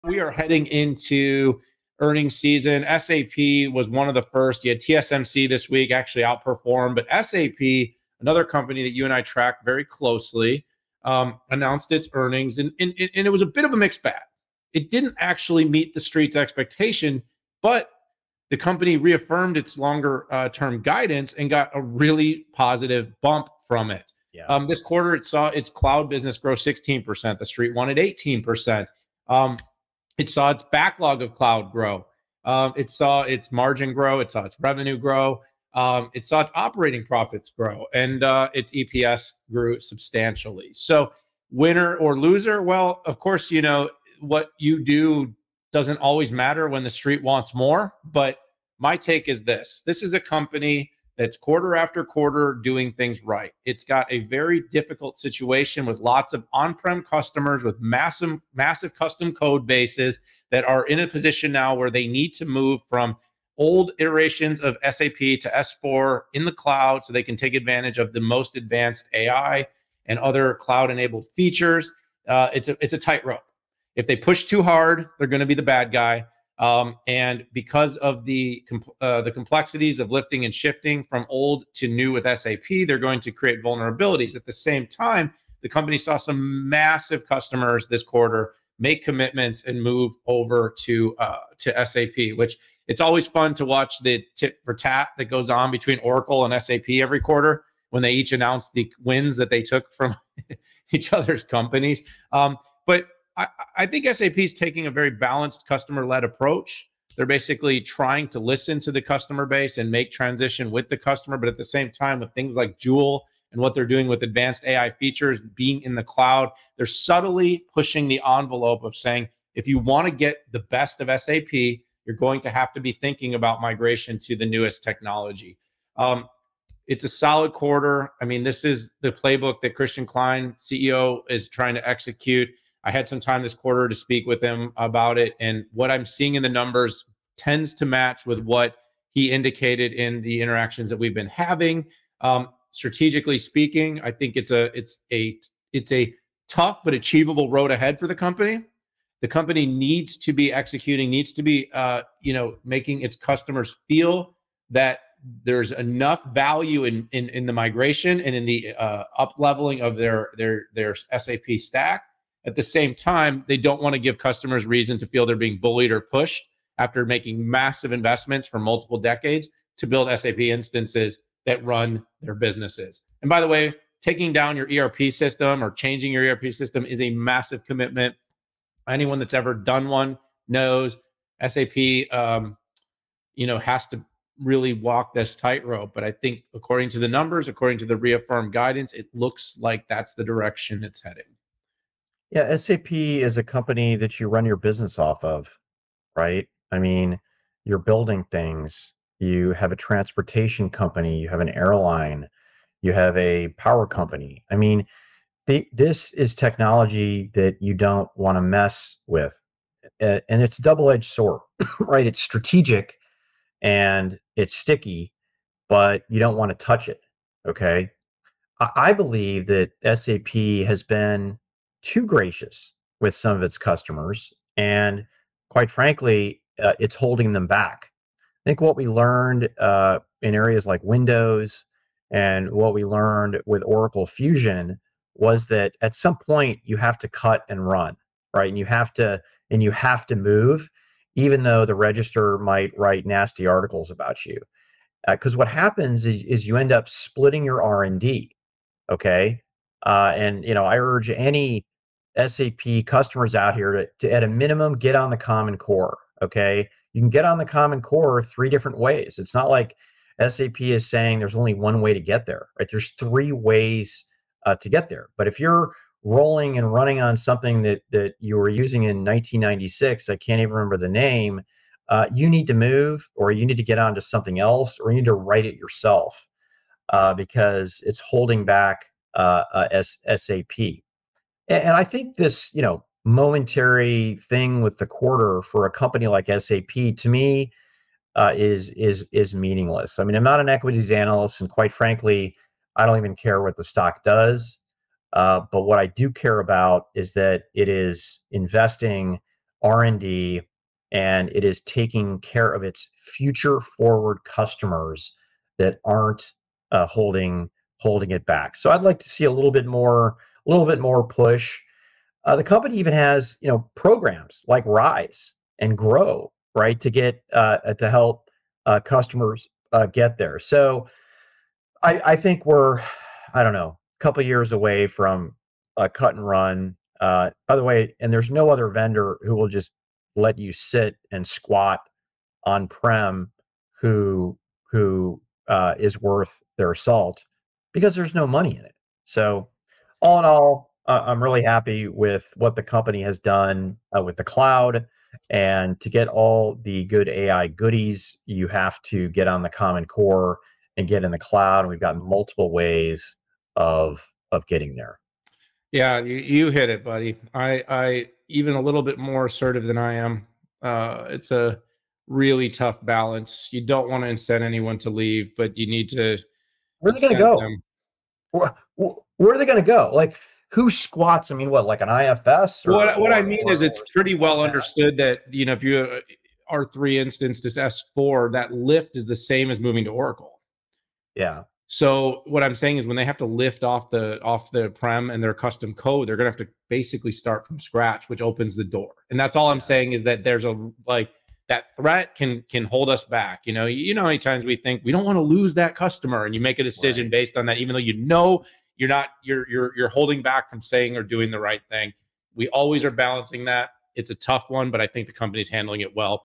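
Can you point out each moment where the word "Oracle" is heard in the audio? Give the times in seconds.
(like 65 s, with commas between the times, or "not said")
95 s, 233 s, 379 s.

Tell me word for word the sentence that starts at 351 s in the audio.
And we've got multiple ways of of getting there.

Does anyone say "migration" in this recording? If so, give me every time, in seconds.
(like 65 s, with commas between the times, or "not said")
123 s, 157 s.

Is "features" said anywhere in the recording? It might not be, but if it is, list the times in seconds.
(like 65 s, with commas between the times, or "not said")
71 s, 114 s.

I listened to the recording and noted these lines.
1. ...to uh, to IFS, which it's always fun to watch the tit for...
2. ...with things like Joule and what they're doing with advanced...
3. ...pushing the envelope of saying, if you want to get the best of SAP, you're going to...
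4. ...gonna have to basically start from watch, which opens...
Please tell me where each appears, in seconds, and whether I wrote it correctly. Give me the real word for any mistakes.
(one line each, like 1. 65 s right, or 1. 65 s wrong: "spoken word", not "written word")
1. 90 s wrong: "SAP", not "IFS"
2. 112 s right
3. 117 s right
4. 386 s wrong: "scratch", not "watch".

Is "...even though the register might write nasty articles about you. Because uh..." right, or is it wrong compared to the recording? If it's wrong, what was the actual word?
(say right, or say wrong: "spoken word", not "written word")
right.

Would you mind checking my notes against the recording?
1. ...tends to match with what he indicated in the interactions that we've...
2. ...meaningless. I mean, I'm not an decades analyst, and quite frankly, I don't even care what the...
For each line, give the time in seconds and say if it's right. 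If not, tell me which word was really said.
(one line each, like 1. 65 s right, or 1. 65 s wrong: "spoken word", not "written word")
1. 137 s right
2. 289 s wrong: "equities", not "decades".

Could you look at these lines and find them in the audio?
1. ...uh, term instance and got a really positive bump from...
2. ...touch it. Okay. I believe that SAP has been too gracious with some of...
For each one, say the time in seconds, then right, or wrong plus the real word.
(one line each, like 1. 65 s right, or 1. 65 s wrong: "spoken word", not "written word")
1. 20 s wrong: "guidance", not "instance"
2. 216 s right.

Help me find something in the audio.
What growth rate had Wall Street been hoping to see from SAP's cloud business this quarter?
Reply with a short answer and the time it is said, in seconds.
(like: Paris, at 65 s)
18%, at 27 s.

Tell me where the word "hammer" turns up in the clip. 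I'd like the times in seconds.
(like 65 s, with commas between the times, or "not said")
not said.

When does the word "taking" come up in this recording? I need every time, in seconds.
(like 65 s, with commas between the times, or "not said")
104 s, 174 s, 301 s.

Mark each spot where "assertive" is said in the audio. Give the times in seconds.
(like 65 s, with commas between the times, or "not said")
359 s.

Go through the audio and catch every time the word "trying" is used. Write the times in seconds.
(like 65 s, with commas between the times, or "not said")
107 s, 131 s.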